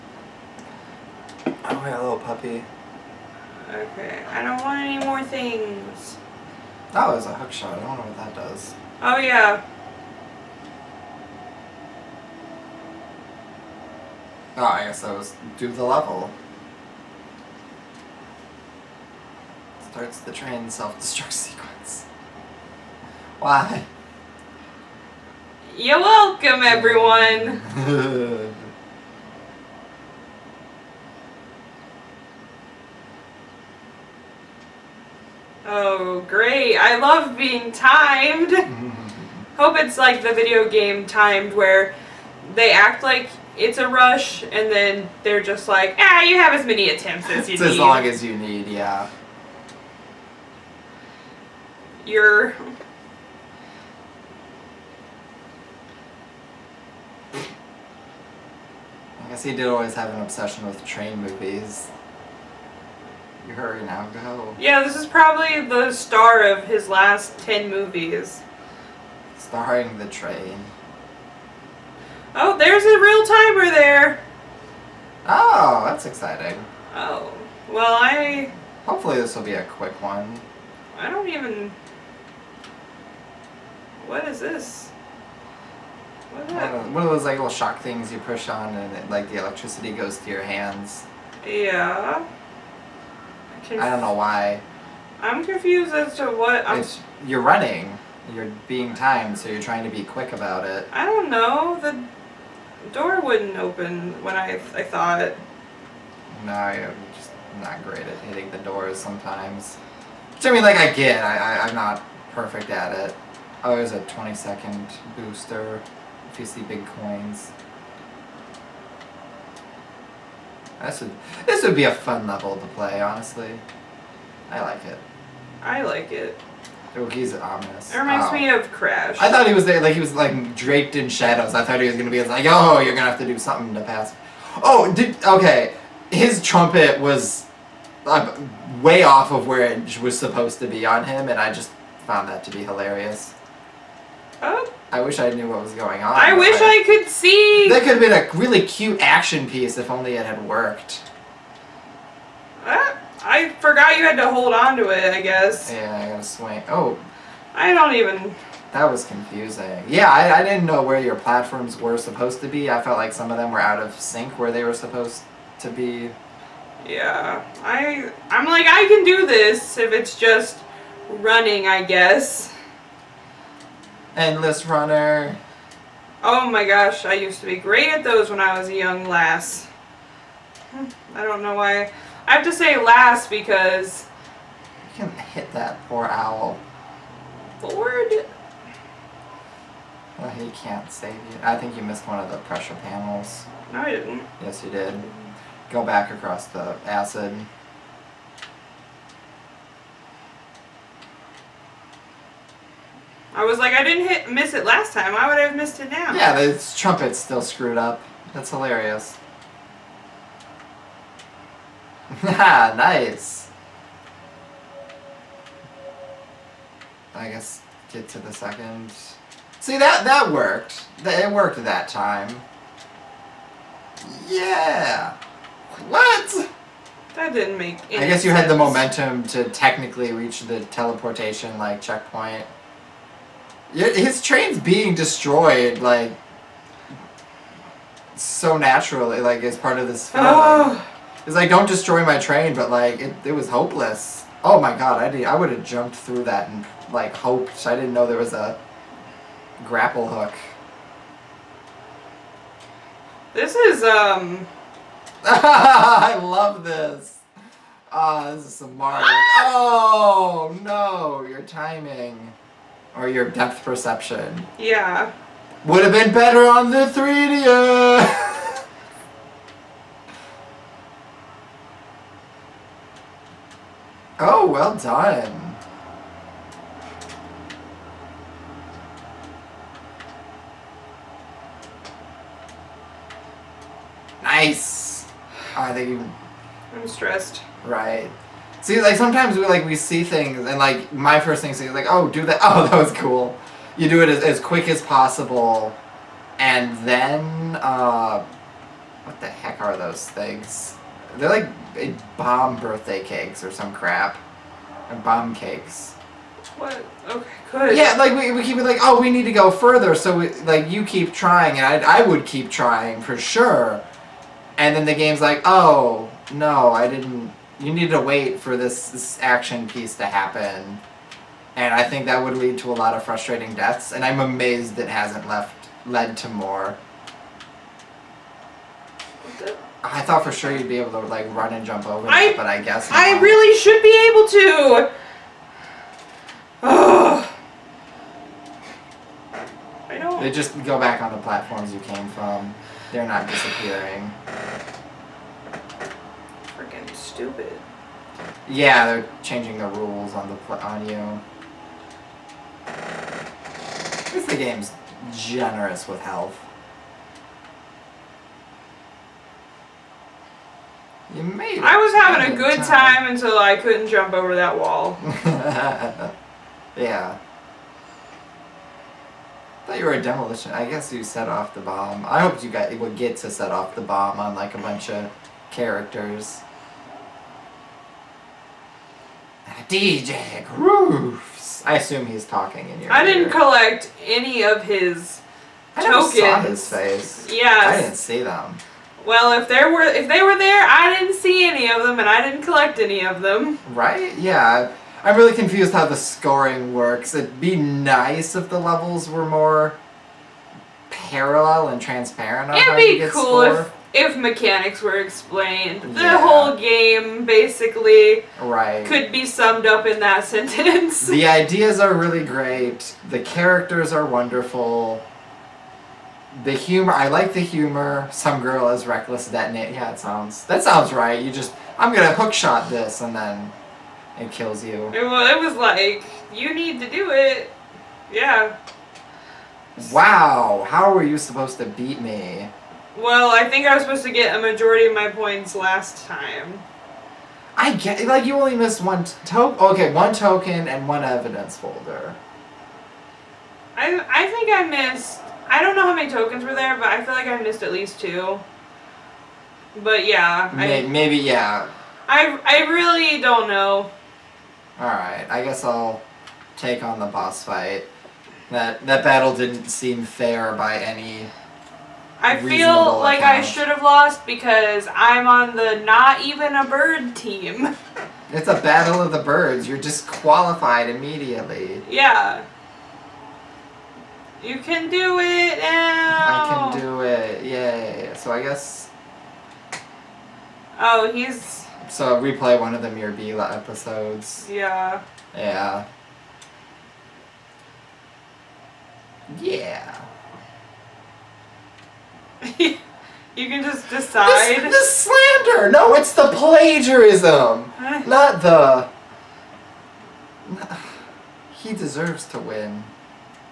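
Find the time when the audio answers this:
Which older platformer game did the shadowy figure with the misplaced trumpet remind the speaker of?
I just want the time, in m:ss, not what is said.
2:08.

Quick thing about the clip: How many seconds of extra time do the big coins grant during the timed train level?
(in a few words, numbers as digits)
20.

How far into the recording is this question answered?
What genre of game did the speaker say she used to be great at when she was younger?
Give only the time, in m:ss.
2:54.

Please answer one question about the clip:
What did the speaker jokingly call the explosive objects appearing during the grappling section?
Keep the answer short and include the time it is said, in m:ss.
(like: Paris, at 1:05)
Bomb cakes, at 5:04.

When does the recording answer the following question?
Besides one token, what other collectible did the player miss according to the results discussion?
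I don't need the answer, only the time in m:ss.
7:21.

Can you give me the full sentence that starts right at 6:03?
time until I couldn't jump over that wall.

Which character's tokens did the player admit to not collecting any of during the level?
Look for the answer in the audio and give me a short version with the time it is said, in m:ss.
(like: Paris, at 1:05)
DJ Grooves, at 6:19.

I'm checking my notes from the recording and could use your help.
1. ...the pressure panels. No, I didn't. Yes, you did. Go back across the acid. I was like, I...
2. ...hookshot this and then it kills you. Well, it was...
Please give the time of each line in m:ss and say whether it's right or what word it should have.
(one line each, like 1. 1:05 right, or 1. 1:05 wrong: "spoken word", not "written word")
1. 3:12 right
2. 7:02 right.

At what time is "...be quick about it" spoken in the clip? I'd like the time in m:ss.
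1:39.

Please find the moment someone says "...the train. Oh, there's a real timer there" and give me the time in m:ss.
1:09.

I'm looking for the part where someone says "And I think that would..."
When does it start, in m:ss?
5:21.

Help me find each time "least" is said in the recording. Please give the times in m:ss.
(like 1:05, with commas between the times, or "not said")
5:54, 7:27.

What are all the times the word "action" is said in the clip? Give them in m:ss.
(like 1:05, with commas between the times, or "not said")
2:29, 5:19.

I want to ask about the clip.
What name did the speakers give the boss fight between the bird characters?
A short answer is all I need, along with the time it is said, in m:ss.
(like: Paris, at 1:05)
Battle of the birds, at 7:48.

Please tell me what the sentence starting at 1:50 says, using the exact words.
Which I mean, like I get.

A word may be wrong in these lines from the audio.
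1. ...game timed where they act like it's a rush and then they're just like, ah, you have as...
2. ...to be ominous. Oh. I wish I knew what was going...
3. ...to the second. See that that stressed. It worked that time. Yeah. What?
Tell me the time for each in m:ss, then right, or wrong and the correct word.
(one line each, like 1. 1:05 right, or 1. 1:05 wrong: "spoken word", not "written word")
1. 0:40 right
2. 2:22 wrong: "hilarious", not "ominous"
3. 3:38 wrong: "worked", not "stressed".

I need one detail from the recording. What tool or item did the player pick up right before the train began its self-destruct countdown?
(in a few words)
Hook shot.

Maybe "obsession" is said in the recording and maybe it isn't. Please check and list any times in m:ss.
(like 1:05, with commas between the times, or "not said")
1:00.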